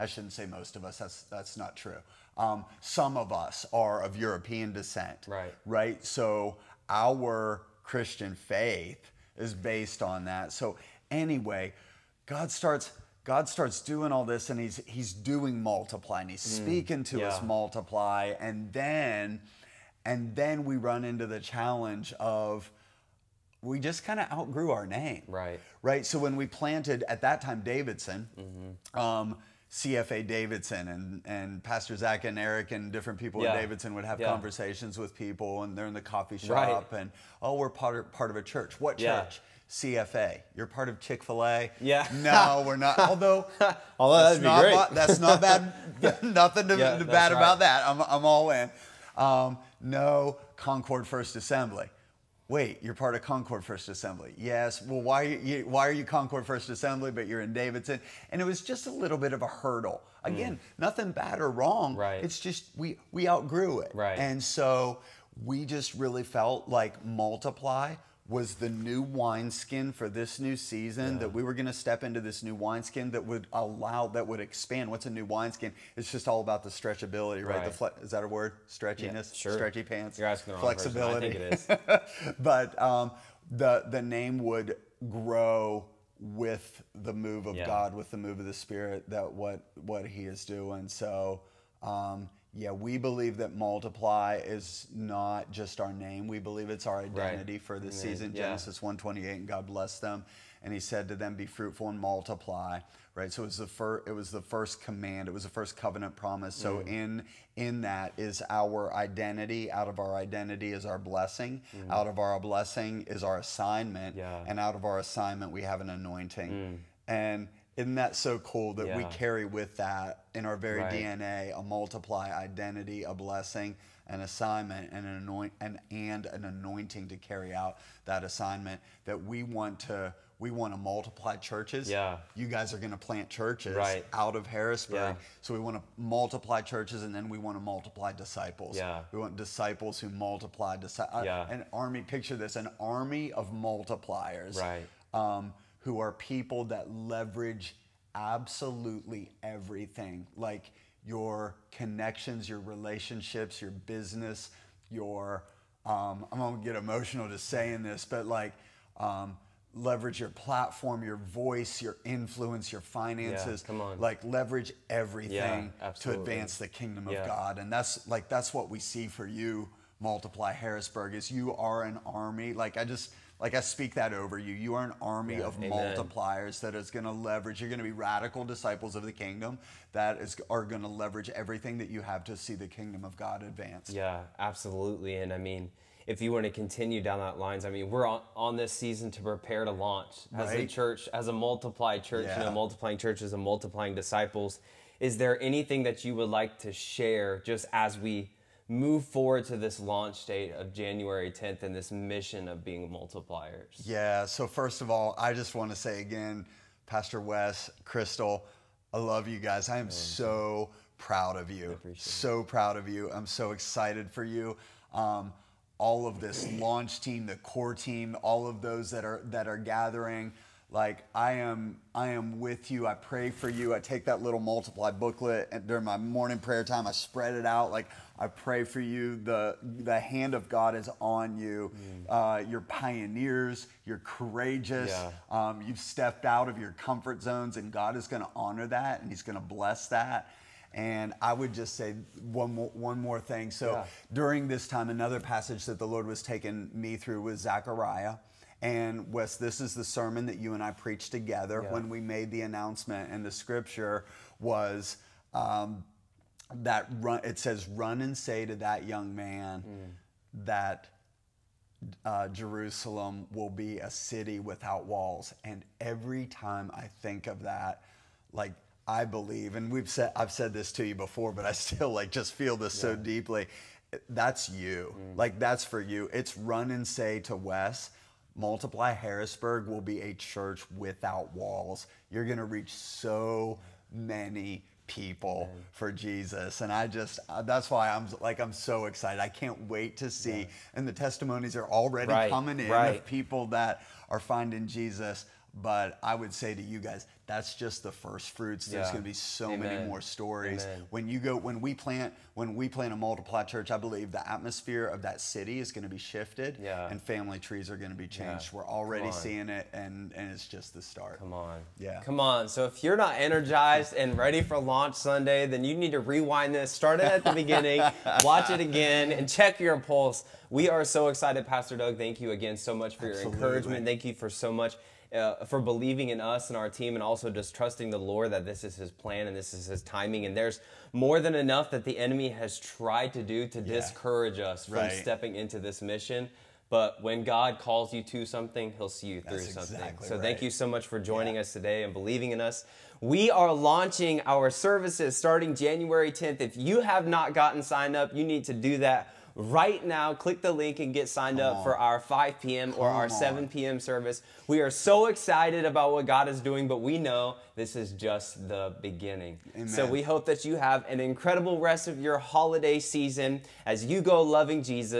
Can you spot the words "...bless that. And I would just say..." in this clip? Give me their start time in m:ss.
3:59.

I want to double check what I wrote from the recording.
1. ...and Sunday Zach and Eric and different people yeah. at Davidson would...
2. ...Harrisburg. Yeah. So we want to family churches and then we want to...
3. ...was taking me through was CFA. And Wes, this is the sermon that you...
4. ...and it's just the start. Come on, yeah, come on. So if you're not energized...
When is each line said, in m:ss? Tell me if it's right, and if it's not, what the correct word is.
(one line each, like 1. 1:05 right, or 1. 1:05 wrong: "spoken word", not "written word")
1. 0:31 wrong: "Pastor", not "Sunday"
2. 2:14 wrong: "multiply", not "family"
3. 4:06 wrong: "Zechariah", not "CFA"
4. 5:10 right.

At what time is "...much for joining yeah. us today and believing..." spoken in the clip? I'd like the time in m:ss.
5:40.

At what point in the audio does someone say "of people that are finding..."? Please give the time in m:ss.
4:52.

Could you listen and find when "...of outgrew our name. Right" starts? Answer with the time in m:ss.
0:24.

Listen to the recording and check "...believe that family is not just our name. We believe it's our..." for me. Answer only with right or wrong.
wrong.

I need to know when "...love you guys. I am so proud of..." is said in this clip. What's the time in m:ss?
3:28.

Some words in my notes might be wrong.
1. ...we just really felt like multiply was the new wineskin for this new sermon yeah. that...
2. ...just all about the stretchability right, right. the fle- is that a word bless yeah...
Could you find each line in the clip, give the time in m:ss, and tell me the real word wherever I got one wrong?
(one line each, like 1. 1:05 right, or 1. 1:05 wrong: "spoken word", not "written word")
1. 1:05 wrong: "season", not "sermon"
2. 1:16 wrong: "stretchiness", not "bless".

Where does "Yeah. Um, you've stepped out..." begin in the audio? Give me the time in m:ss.
3:54.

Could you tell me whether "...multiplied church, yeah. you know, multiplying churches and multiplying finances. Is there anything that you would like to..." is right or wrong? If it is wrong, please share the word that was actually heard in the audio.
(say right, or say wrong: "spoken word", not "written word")
wrong: "disciples", not "finances".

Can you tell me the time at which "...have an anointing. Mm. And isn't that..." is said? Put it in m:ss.
1:55.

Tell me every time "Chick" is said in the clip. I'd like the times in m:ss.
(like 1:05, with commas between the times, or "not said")
0:40.